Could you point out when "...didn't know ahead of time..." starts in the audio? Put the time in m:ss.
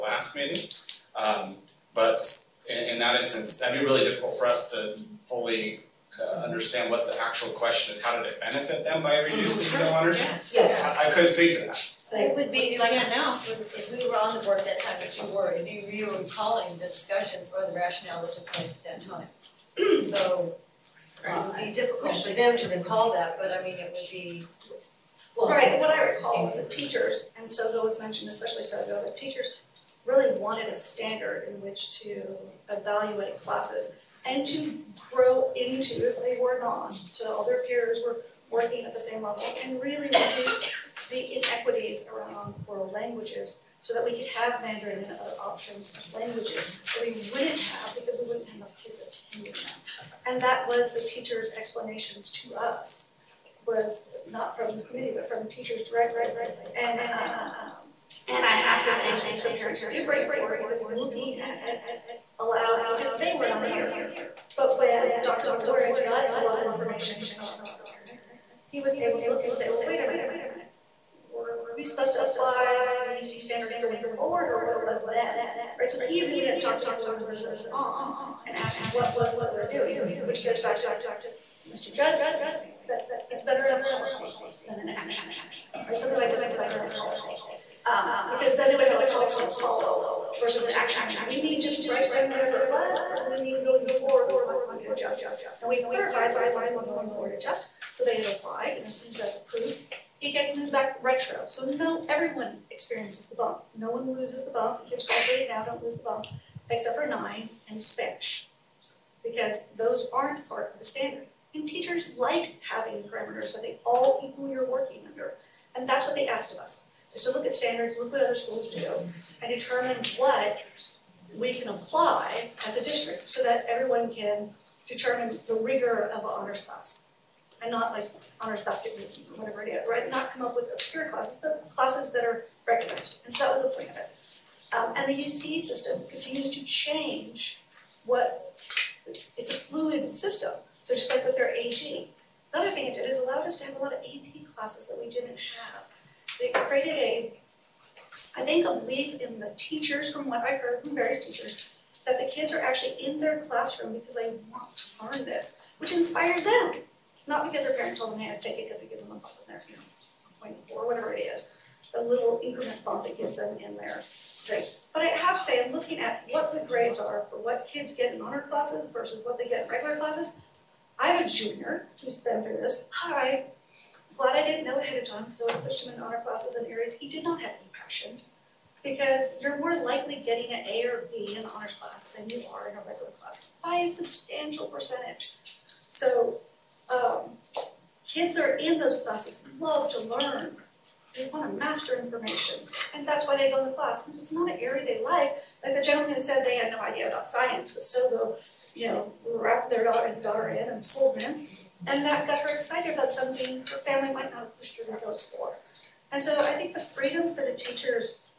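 2:54.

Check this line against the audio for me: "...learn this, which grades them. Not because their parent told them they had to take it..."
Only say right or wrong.
wrong.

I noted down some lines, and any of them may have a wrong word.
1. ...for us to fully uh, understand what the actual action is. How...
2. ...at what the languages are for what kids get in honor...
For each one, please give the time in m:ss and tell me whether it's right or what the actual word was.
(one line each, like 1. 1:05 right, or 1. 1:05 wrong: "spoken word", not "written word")
1. 0:04 wrong: "question", not "action"
2. 2:46 wrong: "grades", not "languages".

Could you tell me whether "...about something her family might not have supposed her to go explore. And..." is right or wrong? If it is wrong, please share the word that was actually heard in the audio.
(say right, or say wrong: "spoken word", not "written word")
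wrong: "pushed", not "supposed".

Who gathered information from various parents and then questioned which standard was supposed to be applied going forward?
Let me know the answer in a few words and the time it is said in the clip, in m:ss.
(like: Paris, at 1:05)
Dr. Viloria, at 1:05.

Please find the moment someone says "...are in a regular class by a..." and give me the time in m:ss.
3:02.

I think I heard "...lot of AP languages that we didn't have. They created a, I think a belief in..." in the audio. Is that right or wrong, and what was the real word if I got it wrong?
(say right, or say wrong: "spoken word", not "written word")
wrong: "classes", not "languages".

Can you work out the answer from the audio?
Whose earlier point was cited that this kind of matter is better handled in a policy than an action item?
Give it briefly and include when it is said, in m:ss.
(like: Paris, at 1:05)
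Mr. Judd, at 1:21.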